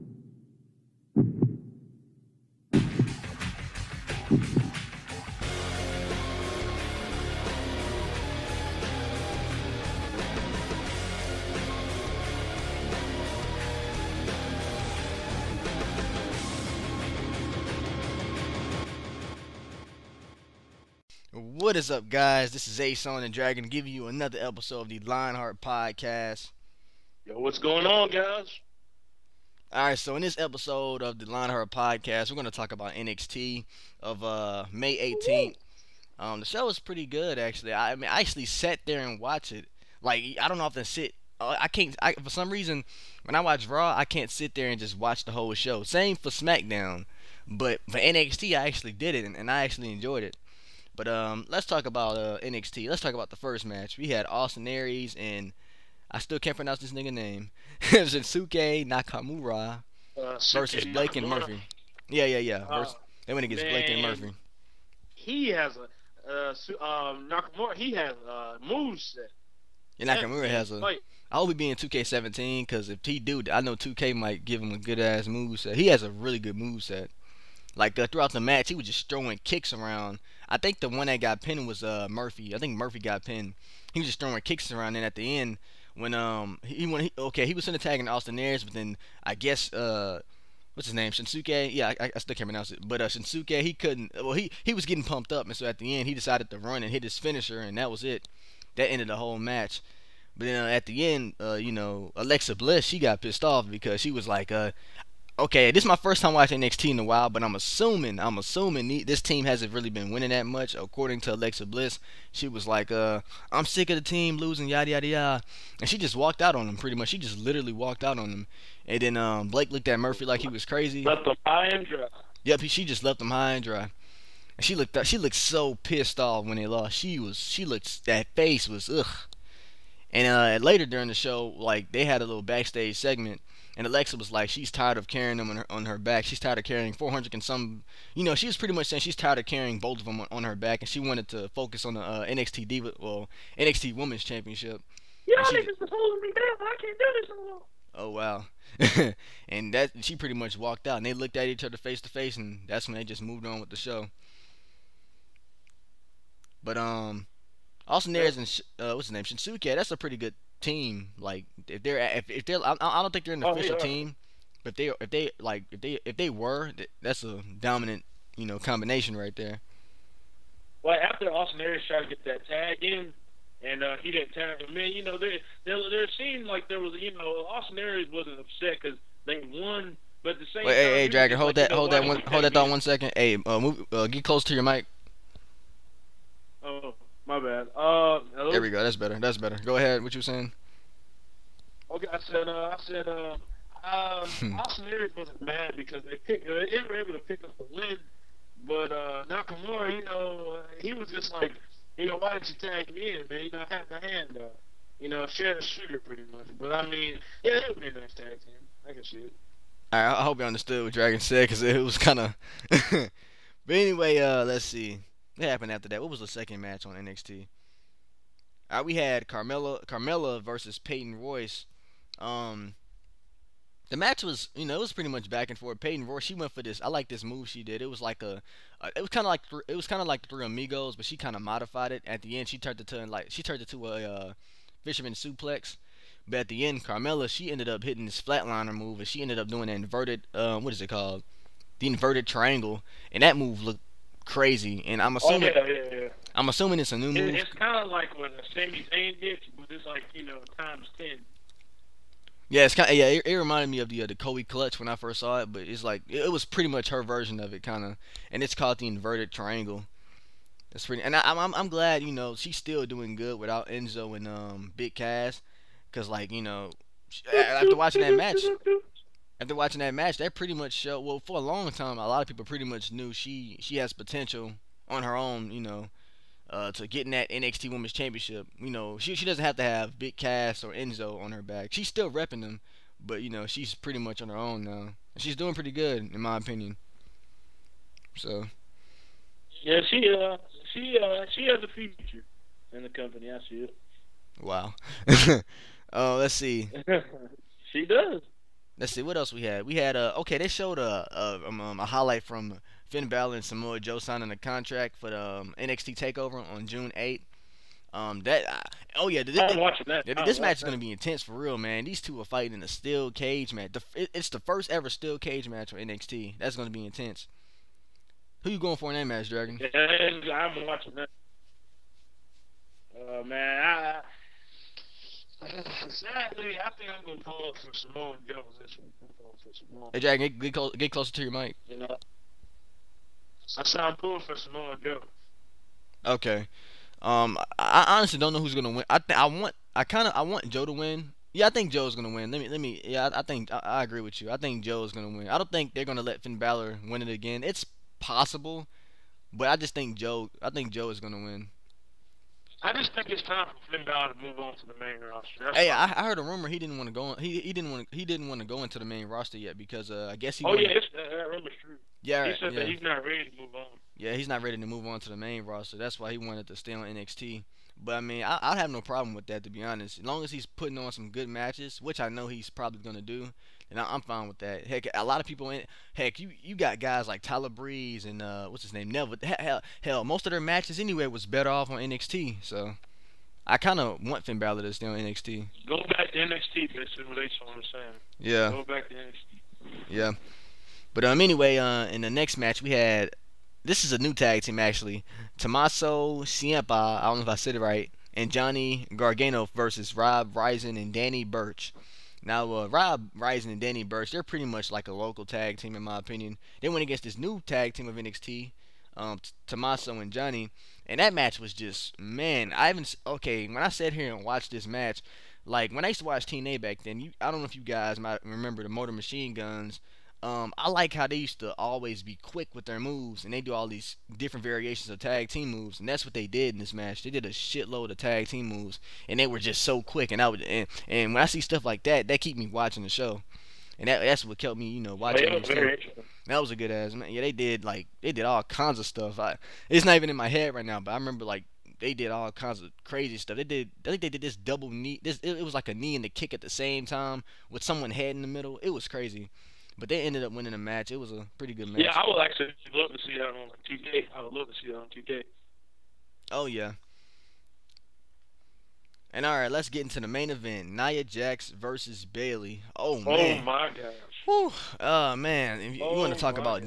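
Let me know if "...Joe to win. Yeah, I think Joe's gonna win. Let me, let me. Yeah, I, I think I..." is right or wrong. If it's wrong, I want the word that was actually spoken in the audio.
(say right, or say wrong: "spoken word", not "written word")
right.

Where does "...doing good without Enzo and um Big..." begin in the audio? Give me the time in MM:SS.
04:22.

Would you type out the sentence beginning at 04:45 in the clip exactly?
And she's doing pretty good, in my opinion.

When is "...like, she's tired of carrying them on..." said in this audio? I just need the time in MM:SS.
02:14.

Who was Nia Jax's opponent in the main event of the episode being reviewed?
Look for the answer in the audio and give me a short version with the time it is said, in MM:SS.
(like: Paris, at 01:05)
Bailey, at 07:42.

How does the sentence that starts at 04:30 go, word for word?
Well, for a long time, a lot of people pretty much knew she she has potential on her own.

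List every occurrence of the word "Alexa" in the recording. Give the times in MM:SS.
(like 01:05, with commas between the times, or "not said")
01:42, 01:51, 02:13.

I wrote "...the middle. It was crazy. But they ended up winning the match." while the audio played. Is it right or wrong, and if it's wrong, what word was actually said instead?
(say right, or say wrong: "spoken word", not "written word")
right.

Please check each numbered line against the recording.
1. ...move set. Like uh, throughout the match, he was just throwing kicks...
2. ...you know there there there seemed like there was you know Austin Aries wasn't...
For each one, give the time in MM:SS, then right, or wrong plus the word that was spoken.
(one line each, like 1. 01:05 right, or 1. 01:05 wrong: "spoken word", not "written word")
1. 01:16 right
2. 02:54 right.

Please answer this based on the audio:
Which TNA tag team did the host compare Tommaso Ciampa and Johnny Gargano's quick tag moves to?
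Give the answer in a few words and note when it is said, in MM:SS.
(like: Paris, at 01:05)
Motor Machine Guns, at 06:58.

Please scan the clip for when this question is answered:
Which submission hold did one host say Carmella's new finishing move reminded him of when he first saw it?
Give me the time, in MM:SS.
04:14.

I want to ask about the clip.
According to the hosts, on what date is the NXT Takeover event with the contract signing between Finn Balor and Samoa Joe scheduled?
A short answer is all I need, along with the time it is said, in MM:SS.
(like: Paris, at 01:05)
June 8th, at 05:06.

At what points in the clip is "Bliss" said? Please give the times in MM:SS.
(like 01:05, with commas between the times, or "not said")
01:42, 01:51.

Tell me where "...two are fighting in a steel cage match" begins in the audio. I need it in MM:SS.
05:11.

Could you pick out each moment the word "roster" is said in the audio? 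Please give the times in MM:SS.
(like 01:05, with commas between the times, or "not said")
05:54, 05:59, 06:05.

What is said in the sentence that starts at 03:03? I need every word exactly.
Hey, uh, move, uh, get close to your mic.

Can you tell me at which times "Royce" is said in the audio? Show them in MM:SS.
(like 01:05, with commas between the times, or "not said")
03:41, 03:46.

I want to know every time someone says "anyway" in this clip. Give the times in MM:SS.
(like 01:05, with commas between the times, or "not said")
03:33, 06:20, 06:31.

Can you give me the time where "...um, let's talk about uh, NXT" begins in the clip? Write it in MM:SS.
00:51.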